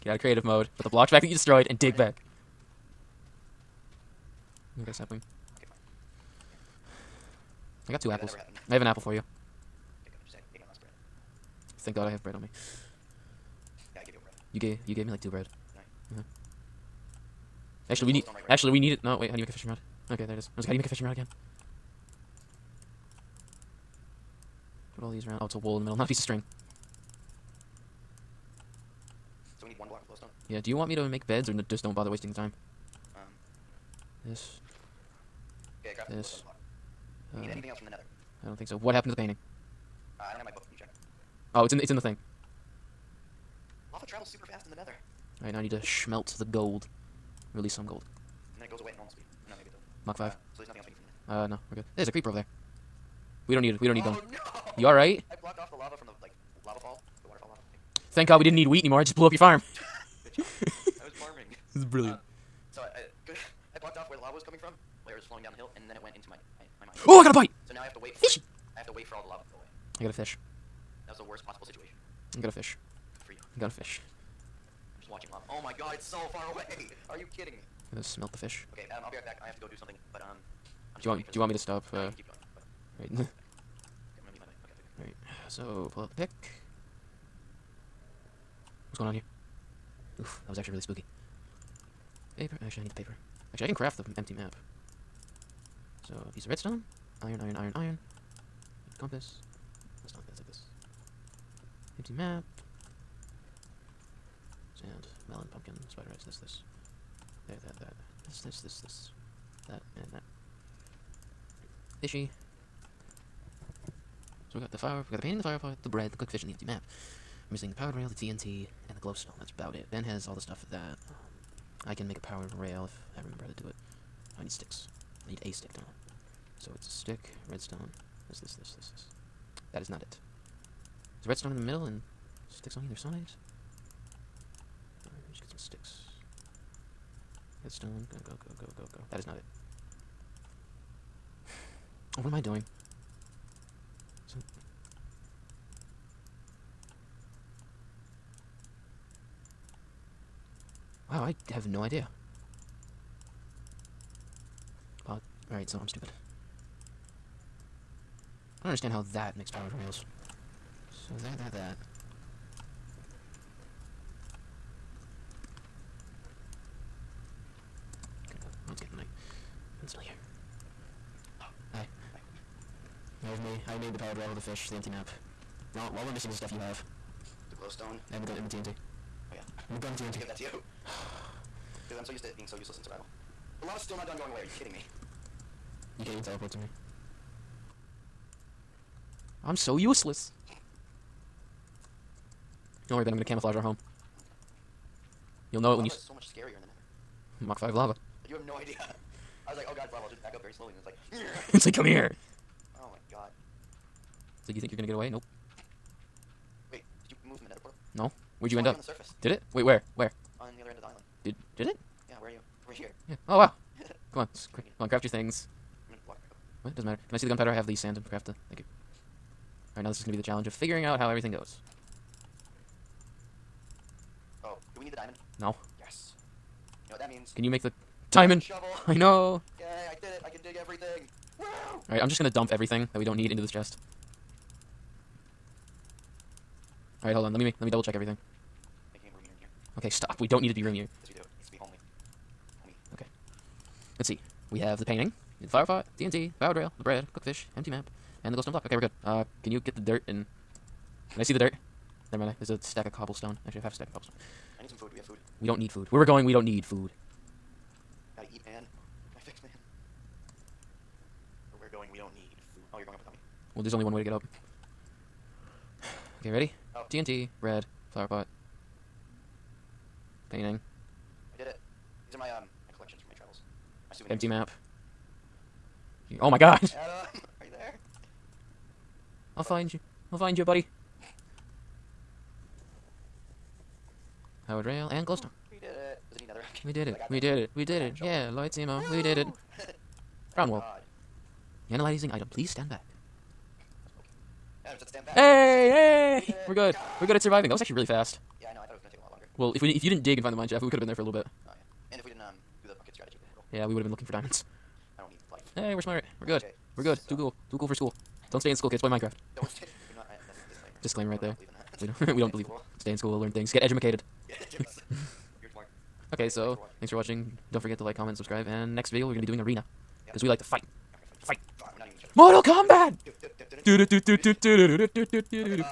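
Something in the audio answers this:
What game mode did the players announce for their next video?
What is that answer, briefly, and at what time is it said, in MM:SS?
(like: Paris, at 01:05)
arena, at 05:19.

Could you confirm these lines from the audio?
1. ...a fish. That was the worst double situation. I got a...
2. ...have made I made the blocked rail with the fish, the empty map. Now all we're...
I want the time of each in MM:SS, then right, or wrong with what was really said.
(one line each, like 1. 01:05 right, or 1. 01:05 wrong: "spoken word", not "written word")
1. 01:10 wrong: "possible", not "double"
2. 02:53 wrong: "powered", not "blocked".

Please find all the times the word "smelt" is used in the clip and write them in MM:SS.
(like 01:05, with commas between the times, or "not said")
00:45, 01:18.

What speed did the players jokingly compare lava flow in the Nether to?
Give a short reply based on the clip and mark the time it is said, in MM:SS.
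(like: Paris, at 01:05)
Mach 5, at 03:17.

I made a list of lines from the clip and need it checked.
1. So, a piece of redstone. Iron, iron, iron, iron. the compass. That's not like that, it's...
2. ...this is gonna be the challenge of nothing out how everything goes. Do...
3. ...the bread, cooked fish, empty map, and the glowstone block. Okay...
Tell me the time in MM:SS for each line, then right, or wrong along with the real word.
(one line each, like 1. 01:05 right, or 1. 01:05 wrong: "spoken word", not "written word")
1. 01:36 right
2. 03:39 wrong: "figuring", not "nothing"
3. 04:06 right.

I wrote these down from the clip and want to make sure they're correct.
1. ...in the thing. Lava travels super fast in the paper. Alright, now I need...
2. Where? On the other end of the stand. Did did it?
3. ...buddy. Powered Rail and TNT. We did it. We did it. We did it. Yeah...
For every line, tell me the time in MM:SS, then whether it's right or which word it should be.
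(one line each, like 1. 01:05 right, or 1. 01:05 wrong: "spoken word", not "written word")
1. 00:41 wrong: "nether", not "paper"
2. 03:29 wrong: "island", not "stand"
3. 04:40 wrong: "Glowstone", not "TNT".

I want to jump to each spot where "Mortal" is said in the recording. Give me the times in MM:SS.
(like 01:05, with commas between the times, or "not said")
05:22.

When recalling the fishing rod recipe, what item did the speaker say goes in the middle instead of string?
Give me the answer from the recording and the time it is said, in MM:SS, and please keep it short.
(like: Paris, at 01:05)
wool, at 00:25.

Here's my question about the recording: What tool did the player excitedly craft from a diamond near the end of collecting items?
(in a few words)
shovel.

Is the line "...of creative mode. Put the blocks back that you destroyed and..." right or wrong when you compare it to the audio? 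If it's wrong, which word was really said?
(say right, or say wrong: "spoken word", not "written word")
right.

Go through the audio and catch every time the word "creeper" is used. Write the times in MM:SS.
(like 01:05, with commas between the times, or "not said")
00:52.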